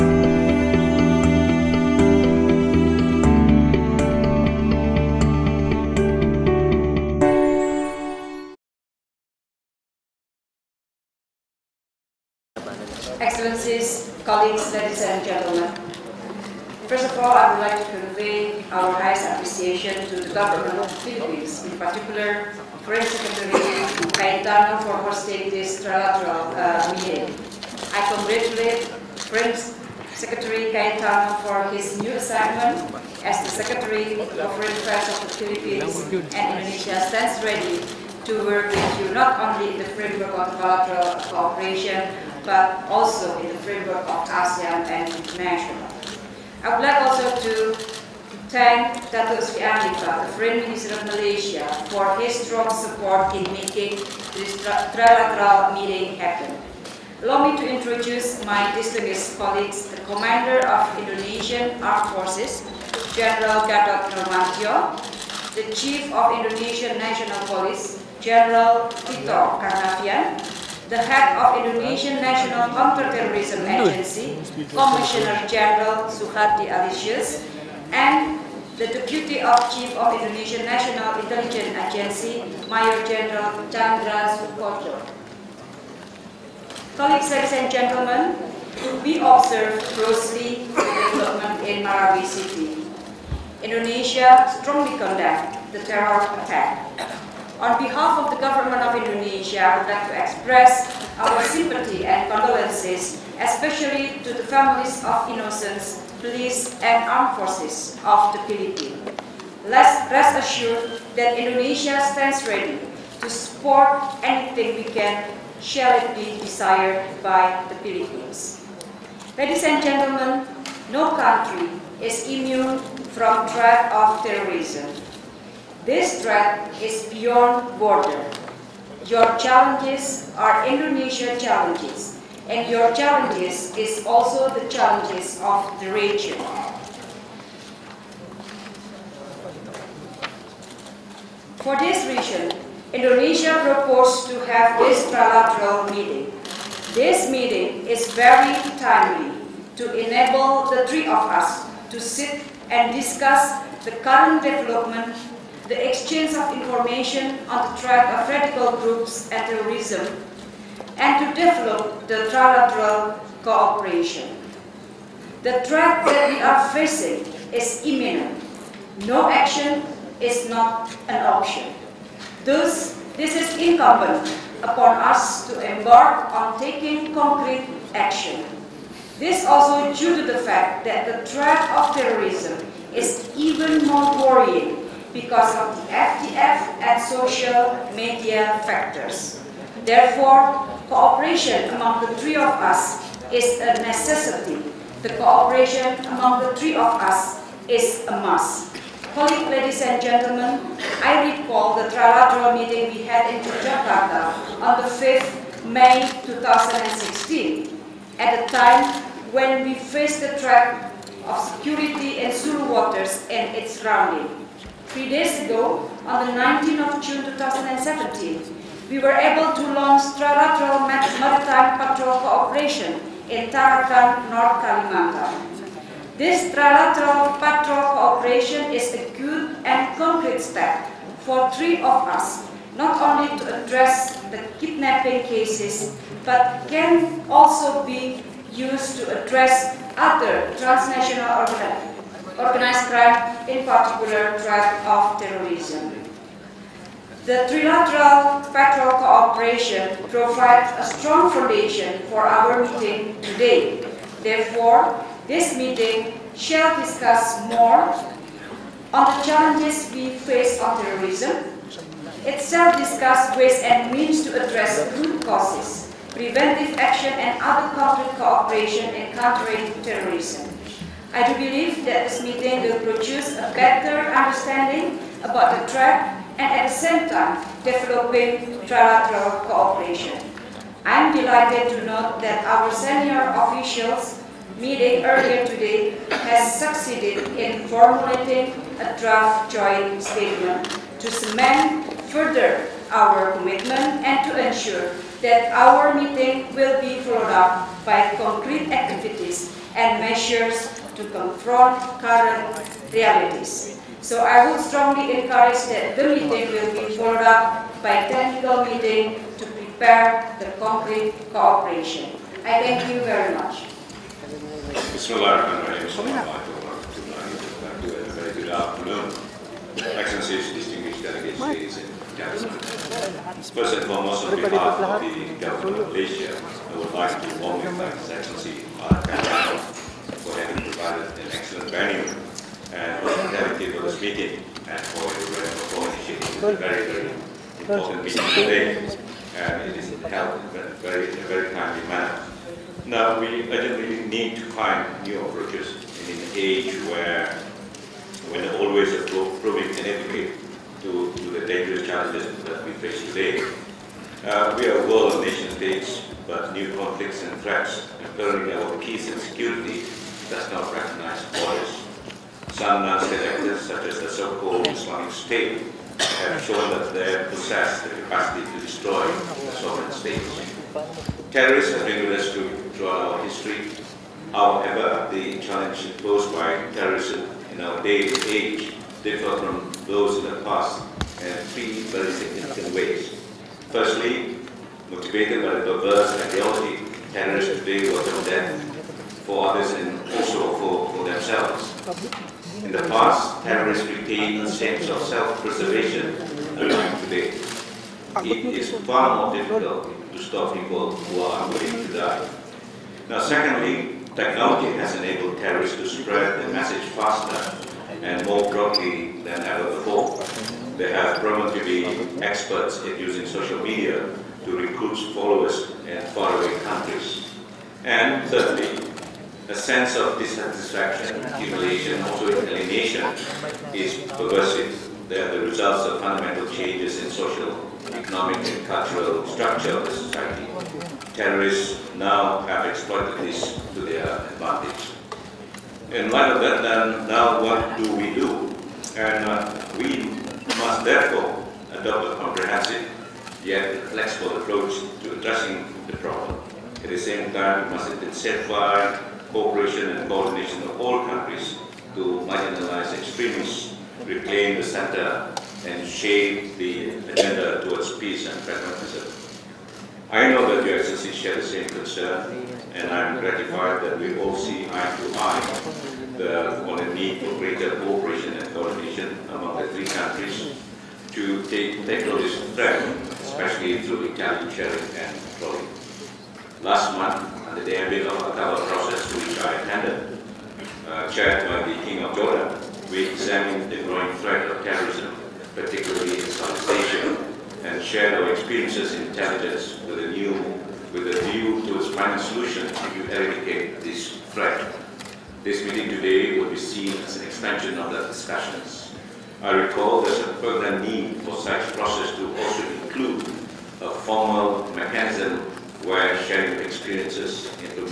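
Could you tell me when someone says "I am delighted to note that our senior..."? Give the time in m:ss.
4:40.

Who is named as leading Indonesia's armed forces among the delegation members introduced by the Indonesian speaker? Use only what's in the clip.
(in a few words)
General Gatot Nurmantyo.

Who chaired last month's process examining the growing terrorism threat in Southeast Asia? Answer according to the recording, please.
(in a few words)
King of Jordan.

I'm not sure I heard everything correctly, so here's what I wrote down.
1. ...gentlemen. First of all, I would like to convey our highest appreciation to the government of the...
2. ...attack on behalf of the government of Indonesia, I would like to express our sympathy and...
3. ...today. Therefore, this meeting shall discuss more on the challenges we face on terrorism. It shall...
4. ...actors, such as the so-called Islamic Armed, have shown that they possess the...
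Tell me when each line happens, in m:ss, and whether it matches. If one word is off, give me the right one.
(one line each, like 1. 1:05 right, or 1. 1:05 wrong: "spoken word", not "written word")
1. 0:15 right
2. 1:36 right
3. 4:13 right
4. 6:03 wrong: "State", not "Armed".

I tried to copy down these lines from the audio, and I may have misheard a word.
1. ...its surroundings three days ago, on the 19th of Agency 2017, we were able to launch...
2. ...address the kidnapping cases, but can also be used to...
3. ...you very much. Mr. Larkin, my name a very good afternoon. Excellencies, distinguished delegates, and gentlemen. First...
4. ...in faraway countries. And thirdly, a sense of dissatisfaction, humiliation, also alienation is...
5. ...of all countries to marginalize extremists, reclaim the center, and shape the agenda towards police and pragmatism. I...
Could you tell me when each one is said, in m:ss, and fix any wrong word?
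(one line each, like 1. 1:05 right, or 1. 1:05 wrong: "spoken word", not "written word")
1. 3:33 wrong: "June", not "Agency"
2. 3:53 right
3. 5:12 right
4. 6:55 right
5. 7:30 wrong: "peace", not "police".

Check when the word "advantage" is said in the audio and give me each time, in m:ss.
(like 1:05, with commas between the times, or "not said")
7:14.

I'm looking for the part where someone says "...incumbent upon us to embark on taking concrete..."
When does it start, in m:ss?
2:53.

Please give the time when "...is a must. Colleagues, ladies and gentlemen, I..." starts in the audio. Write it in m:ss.
3:17.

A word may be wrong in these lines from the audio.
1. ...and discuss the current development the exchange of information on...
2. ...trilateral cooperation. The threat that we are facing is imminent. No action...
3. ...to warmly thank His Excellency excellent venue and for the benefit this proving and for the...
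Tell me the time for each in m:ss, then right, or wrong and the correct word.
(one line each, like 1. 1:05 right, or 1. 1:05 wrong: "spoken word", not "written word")
1. 2:32 right
2. 2:42 right
3. 5:27 wrong: "meeting", not "proving".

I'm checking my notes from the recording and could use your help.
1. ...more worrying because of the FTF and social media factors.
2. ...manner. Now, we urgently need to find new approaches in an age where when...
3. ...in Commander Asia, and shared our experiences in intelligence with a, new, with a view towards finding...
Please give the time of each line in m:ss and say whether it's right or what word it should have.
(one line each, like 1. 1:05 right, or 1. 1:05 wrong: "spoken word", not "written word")
1. 3:03 right
2. 5:41 right
3. 8:06 wrong: "Southeast", not "Commander".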